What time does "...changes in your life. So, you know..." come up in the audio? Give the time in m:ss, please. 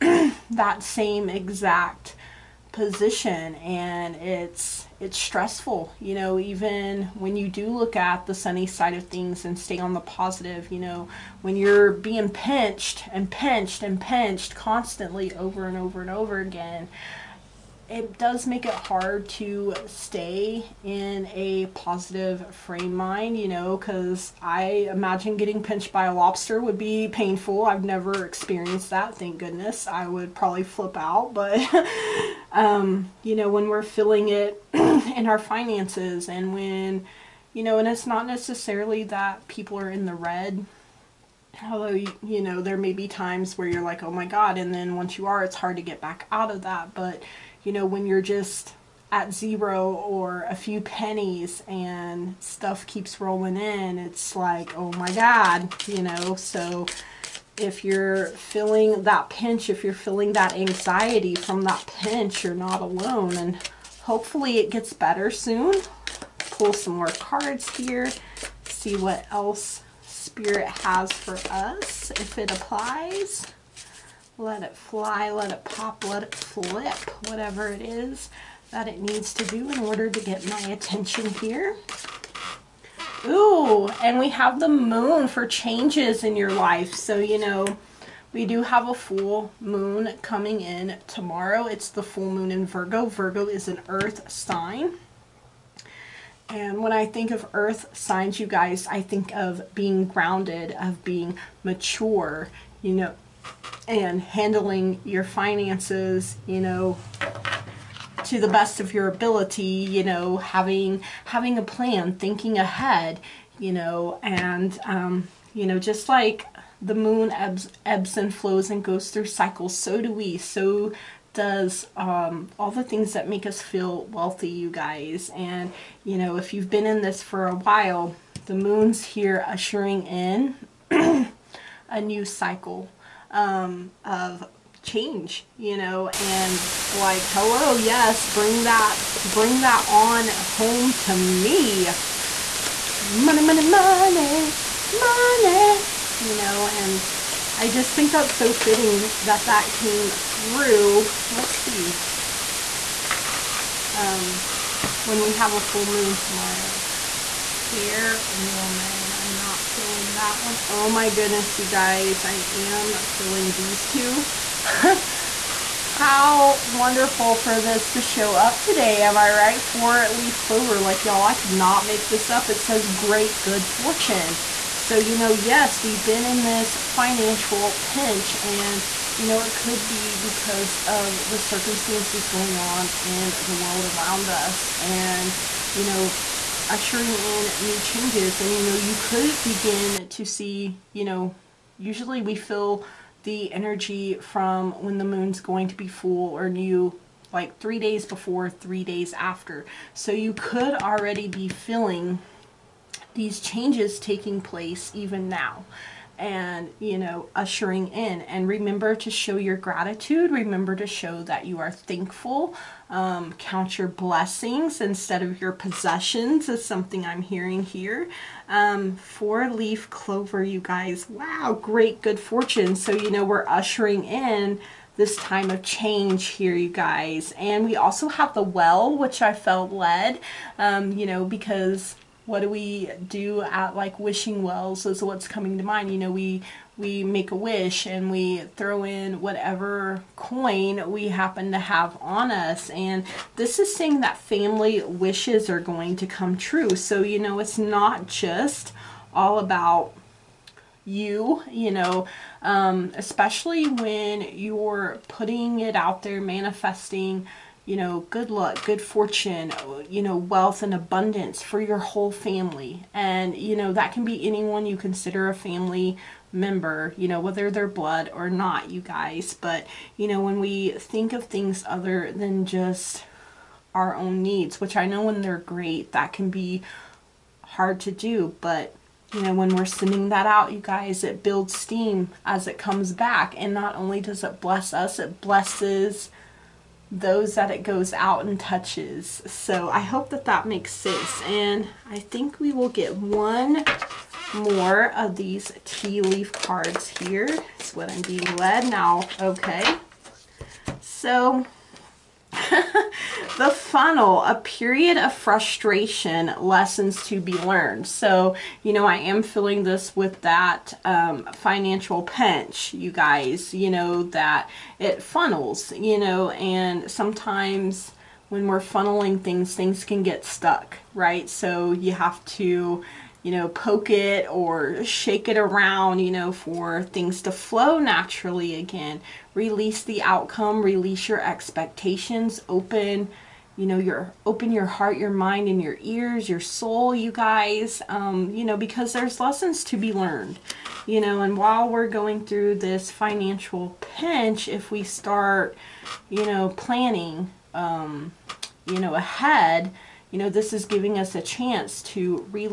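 1:25.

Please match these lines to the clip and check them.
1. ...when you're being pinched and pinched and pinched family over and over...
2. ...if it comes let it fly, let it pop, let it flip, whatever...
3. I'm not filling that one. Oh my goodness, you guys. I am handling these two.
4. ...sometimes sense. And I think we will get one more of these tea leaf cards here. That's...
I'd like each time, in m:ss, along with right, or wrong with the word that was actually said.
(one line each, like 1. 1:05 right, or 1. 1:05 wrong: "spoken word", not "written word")
1. 0:11 wrong: "constantly", not "family"
2. 1:12 wrong: "applies", not "comes"
3. 2:39 wrong: "filling", not "handling"
4. 4:50 wrong: "makes", not "sometimes".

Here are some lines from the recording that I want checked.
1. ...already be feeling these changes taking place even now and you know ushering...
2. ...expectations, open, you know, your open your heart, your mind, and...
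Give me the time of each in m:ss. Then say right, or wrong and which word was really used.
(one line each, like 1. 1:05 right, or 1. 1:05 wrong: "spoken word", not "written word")
1. 3:20 right
2. 5:31 right.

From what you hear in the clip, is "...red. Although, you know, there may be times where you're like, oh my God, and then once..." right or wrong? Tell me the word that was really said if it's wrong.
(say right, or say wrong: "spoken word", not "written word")
right.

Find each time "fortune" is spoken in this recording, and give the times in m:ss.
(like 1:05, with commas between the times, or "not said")
2:53, 3:42, 4:18.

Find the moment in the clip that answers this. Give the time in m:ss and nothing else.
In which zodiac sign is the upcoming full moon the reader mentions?
1:32.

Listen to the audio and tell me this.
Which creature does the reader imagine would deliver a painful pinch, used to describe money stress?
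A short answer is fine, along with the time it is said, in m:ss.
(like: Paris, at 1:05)
lobster, at 0:26.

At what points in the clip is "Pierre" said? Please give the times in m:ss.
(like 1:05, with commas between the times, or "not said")
not said.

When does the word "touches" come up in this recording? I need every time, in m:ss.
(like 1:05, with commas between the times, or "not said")
4:48.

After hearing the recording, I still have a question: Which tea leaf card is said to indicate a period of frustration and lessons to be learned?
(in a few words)
the funnel.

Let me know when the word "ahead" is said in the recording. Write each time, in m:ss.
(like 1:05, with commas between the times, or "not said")
1:52, 5:48.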